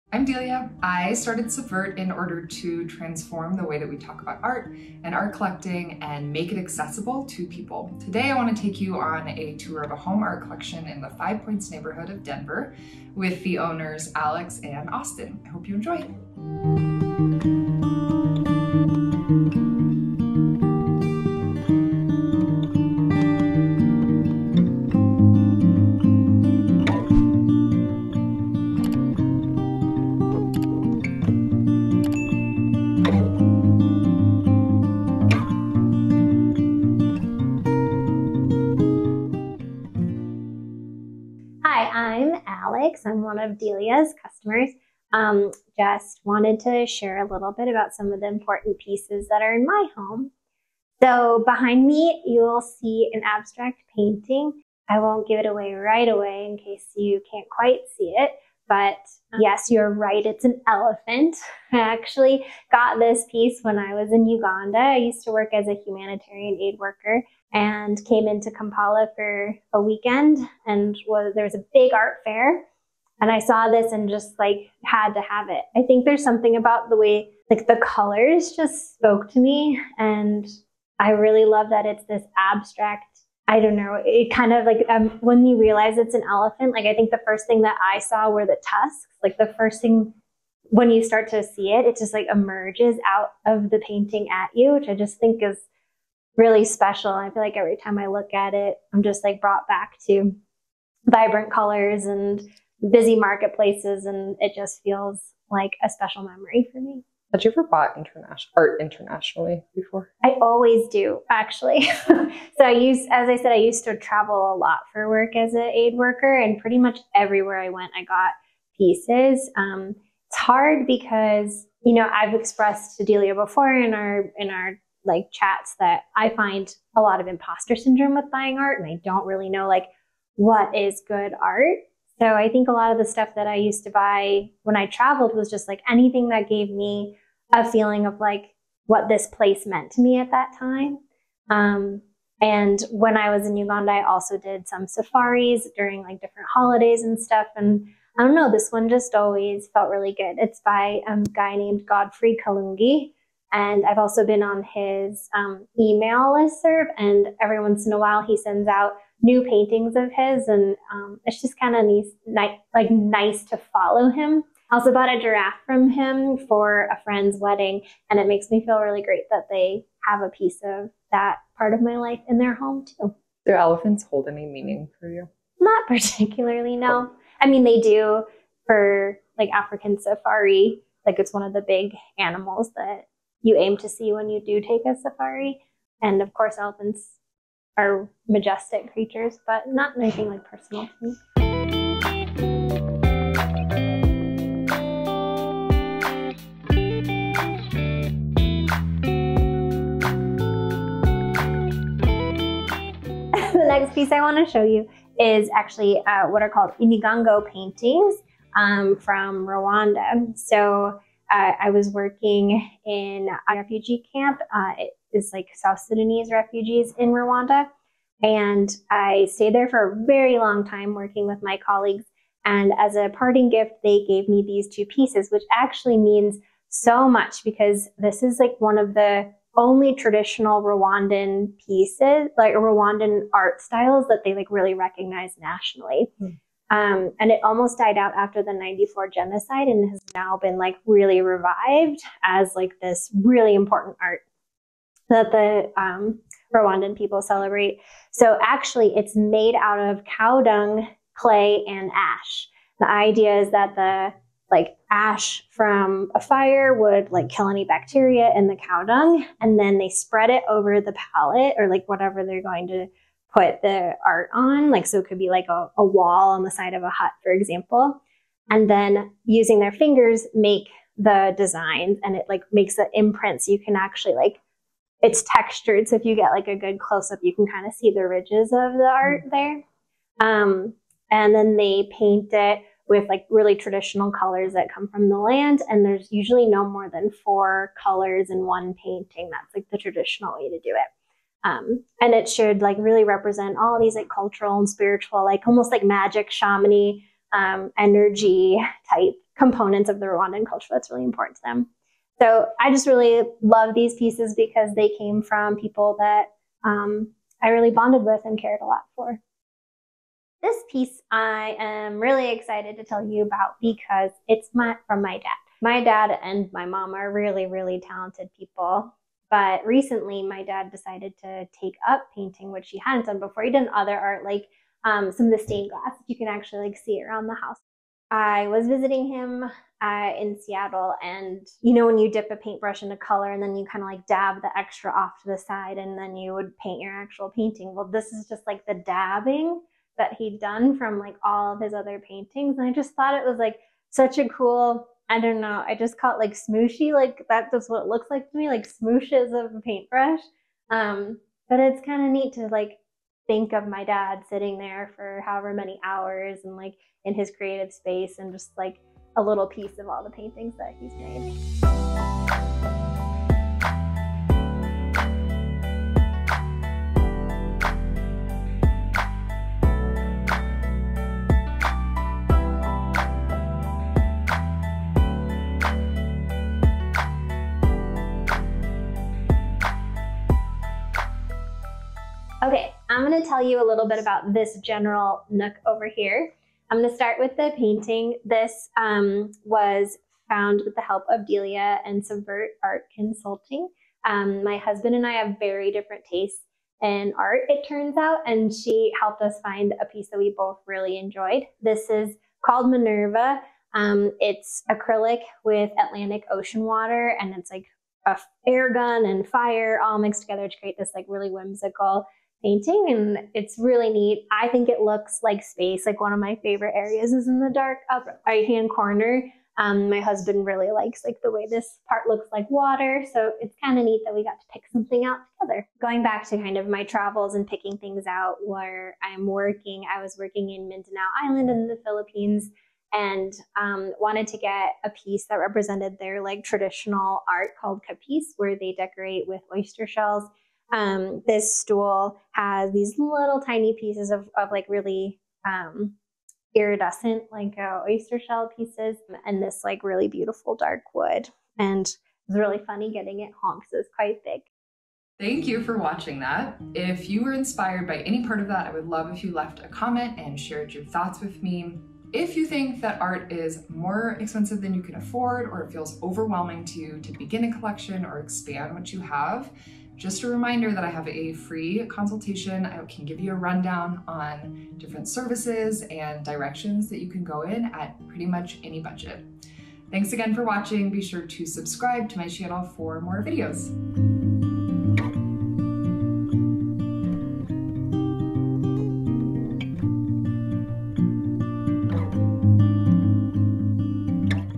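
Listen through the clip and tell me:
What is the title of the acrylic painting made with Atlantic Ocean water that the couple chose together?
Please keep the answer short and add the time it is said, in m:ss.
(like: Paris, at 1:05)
Minerva, at 6:42.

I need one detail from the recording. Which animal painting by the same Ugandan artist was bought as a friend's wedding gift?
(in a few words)
giraffe.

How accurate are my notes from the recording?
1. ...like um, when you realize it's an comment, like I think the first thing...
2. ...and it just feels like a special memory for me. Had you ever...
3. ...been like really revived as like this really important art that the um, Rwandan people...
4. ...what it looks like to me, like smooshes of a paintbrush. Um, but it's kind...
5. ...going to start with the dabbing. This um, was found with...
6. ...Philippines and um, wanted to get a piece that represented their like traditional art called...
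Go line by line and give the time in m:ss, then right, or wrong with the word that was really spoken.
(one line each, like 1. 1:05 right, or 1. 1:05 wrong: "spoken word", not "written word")
1. 1:24 wrong: "elephant", not "comment"
2. 1:44 right
3. 4:00 right
4. 5:47 right
5. 6:26 wrong: "painting", not "dabbing"
6. 7:11 right.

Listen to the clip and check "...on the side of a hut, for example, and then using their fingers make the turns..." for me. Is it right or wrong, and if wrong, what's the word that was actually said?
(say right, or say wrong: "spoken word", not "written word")
wrong: "designs", not "turns".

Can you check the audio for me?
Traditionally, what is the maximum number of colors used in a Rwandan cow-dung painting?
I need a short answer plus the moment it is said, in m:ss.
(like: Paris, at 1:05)
4, at 4:47.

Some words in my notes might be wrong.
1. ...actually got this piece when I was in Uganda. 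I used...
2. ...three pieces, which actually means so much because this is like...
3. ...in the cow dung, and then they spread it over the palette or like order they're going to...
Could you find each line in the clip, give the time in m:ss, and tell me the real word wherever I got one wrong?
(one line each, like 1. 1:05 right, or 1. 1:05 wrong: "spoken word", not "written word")
1. 1:01 right
2. 3:44 wrong: "two", not "three"
3. 4:18 wrong: "whatever", not "order".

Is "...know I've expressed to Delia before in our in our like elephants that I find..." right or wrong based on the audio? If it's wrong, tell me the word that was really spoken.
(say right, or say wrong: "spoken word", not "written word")
wrong: "chats", not "elephants".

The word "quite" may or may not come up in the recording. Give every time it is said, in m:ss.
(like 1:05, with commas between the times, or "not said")
0:57, 7:33.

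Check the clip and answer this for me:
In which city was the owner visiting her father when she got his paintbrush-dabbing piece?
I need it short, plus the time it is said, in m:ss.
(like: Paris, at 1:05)
Seattle, at 5:30.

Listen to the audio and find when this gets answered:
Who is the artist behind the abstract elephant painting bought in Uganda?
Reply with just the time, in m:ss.
2:31.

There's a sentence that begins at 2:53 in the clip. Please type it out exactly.
Do elephants hold any meaning for you?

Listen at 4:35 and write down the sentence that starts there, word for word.
So if you get like a good close up, you can kind of see the ridges of the art mm.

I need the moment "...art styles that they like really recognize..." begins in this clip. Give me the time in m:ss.
3:53.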